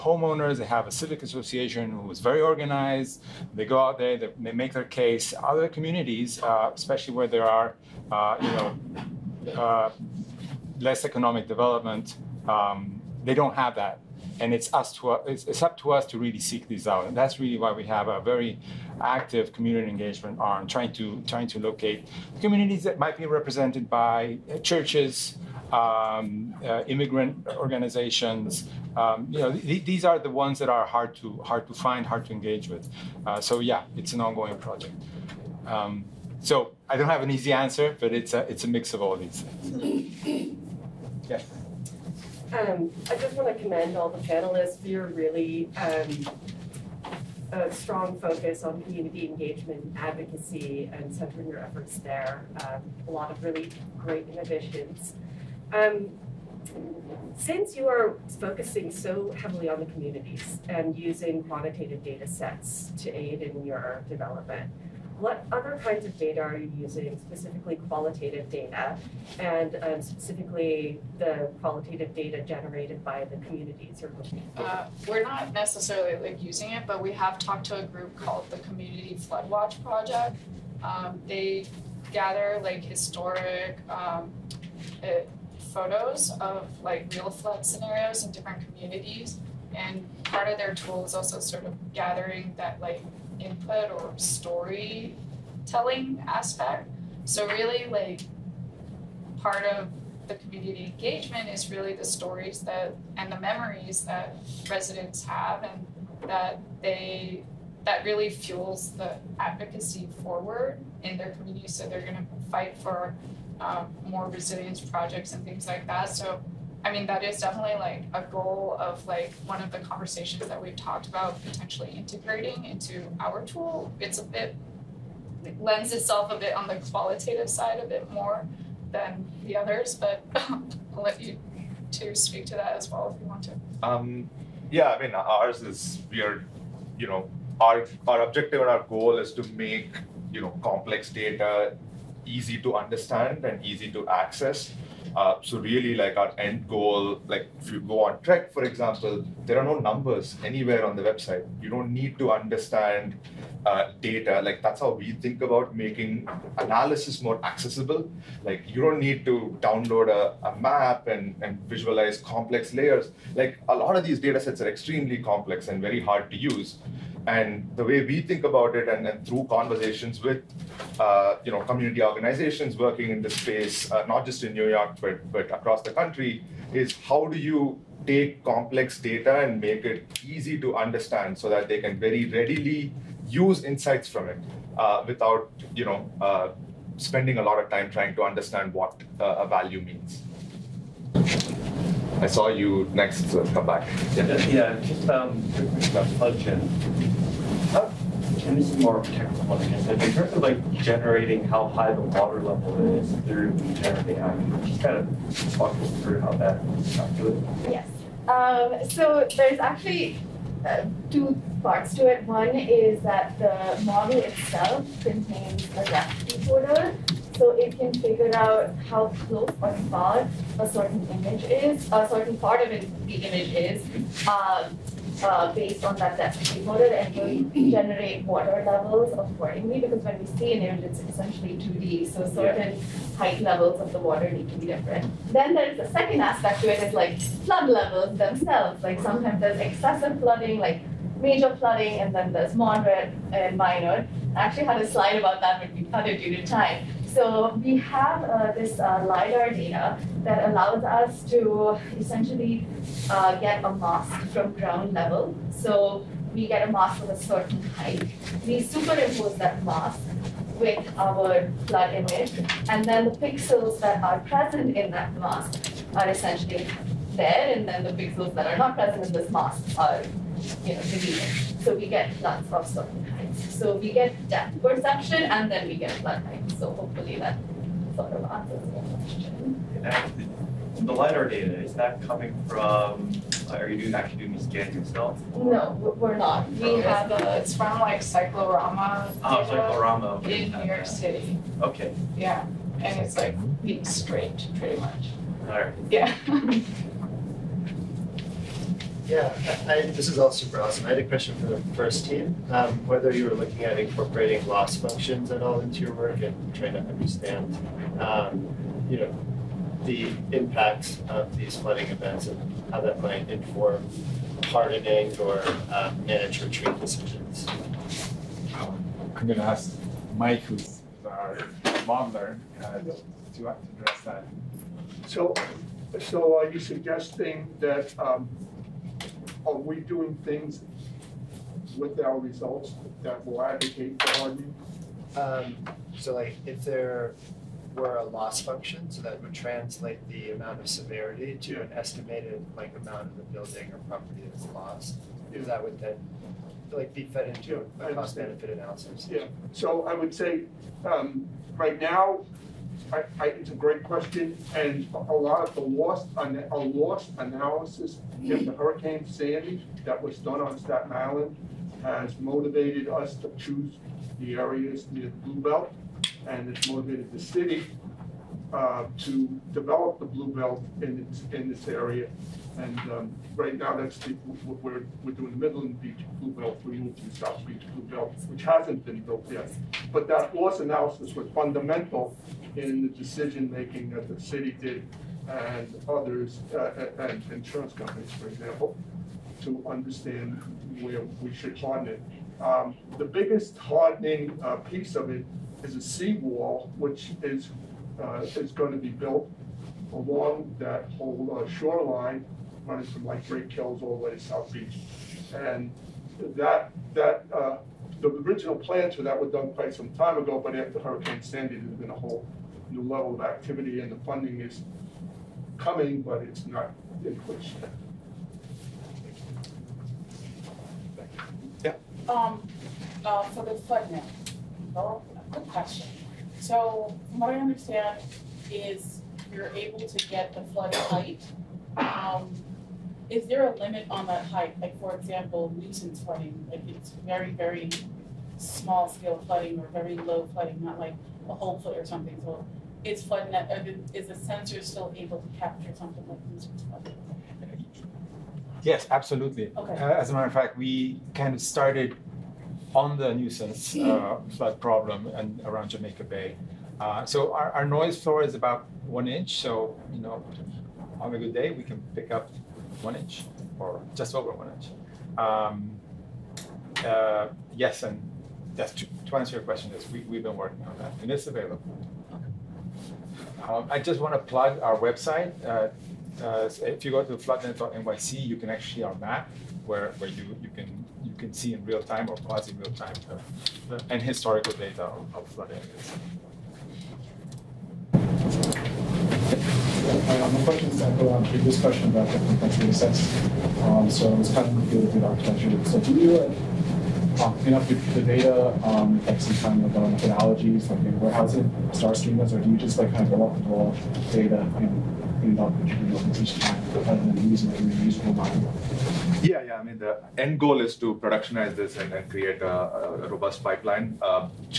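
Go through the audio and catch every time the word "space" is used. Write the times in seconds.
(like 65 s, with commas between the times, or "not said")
173 s.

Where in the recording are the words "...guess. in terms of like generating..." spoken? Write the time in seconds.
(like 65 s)
199 s.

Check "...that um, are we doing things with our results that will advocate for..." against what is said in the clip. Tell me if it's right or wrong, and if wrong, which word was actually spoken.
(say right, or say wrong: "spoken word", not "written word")
right.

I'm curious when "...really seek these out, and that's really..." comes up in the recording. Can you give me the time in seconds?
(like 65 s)
16 s.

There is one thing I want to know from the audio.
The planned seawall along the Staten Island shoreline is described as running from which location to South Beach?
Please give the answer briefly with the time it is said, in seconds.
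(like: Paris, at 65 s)
Great Kills, at 403 s.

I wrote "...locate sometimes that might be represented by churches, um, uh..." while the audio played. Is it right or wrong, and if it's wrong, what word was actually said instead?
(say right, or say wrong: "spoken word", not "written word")
wrong: "communities", not "sometimes".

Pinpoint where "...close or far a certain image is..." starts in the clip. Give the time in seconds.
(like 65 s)
219 s.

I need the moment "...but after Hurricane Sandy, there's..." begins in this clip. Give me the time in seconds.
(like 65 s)
410 s.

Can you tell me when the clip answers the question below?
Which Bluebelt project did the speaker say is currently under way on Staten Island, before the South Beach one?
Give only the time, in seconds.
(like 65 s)
375 s.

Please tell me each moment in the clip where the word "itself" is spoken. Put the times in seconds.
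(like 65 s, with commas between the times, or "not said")
125 s, 214 s.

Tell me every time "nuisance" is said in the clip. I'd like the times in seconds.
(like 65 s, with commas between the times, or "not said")
435 s, 453 s.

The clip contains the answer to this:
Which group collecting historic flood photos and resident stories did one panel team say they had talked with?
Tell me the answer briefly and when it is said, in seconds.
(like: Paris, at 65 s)
Community Flood Watch Project, at 78 s.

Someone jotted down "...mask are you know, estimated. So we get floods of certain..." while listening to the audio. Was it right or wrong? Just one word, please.
wrong.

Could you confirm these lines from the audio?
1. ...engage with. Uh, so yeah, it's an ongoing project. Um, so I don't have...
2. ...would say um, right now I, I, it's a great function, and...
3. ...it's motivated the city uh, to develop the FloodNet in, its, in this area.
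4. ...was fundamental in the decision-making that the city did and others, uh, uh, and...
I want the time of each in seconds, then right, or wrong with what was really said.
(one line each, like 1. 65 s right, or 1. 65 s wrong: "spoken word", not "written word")
1. 32 s right
2. 349 s wrong: "question", not "function"
3. 366 s wrong: "Bluebelt", not "FloodNet"
4. 381 s right.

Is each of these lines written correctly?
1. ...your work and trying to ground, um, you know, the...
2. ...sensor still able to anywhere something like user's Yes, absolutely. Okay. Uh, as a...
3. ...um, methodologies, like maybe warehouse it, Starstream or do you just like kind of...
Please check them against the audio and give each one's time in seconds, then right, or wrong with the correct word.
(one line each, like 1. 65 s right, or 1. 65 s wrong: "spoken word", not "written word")
1. 305 s wrong: "understand", not "ground"
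2. 444 s wrong: "capture", not "anywhere"
3. 499 s right.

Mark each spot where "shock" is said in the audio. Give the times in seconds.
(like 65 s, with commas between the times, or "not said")
not said.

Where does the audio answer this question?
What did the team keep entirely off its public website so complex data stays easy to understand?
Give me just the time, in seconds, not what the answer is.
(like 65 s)
149 s.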